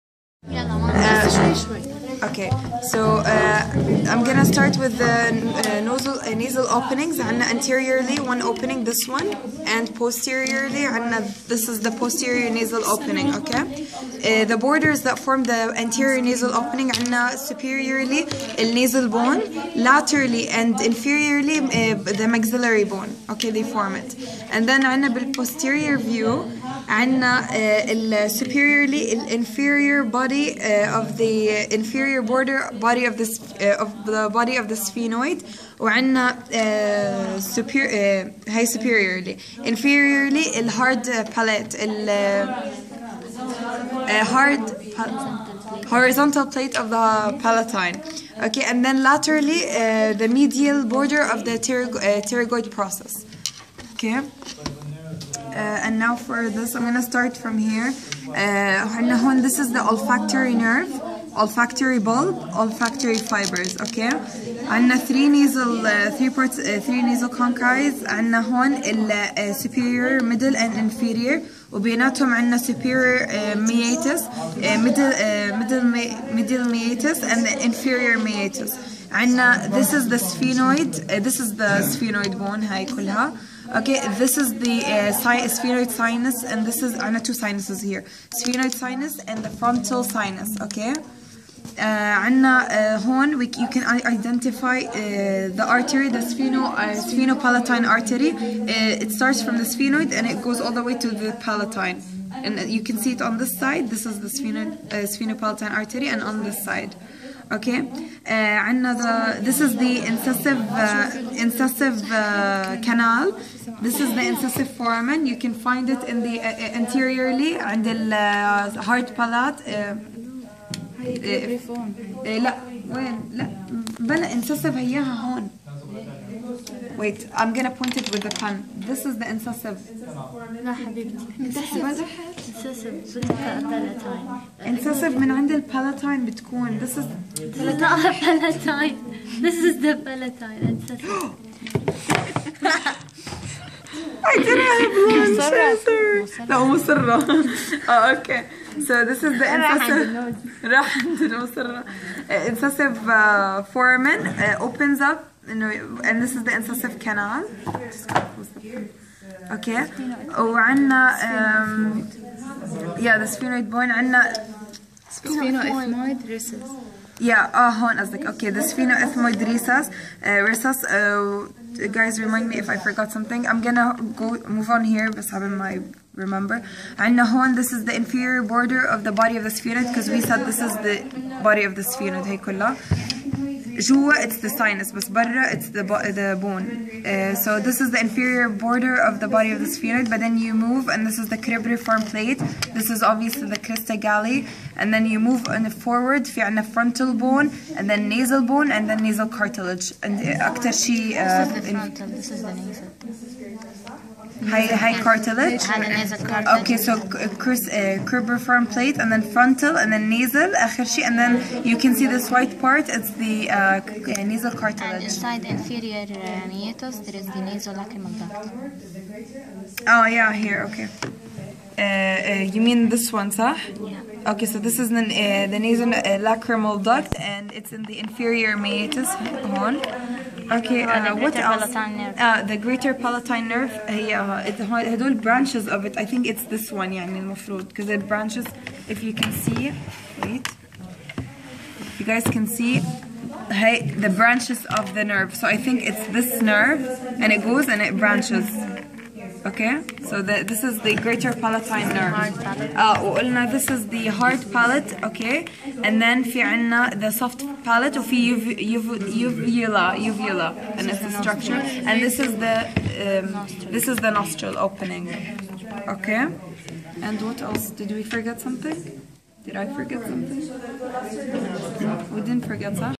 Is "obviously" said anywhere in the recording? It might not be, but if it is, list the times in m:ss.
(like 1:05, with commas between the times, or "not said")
3:13.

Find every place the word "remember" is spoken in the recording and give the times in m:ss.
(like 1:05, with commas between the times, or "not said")
2:56.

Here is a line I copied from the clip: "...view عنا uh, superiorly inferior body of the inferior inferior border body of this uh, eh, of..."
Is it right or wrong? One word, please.
wrong.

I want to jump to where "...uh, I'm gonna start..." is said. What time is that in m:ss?
0:03.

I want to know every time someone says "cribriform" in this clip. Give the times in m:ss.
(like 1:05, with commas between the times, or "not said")
3:11, 3:28.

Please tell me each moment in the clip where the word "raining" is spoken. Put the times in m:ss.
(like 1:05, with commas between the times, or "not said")
not said.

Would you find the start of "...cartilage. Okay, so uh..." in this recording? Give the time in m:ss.
3:25.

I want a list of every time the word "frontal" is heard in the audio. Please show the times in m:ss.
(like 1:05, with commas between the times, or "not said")
1:29, 3:16, 3:21, 3:29.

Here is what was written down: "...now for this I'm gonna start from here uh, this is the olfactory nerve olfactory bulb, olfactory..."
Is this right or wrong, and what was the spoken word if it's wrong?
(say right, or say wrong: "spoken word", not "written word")
right.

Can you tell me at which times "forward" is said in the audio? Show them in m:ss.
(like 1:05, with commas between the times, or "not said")
3:15.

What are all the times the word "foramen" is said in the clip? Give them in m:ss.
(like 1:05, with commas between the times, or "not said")
1:54, 2:33.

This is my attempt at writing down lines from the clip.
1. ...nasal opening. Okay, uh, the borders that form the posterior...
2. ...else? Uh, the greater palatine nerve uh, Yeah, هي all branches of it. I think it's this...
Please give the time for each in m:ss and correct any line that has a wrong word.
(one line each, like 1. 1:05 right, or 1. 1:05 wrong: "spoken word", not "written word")
1. 0:12 wrong: "anterior", not "posterior"
2. 3:51 right.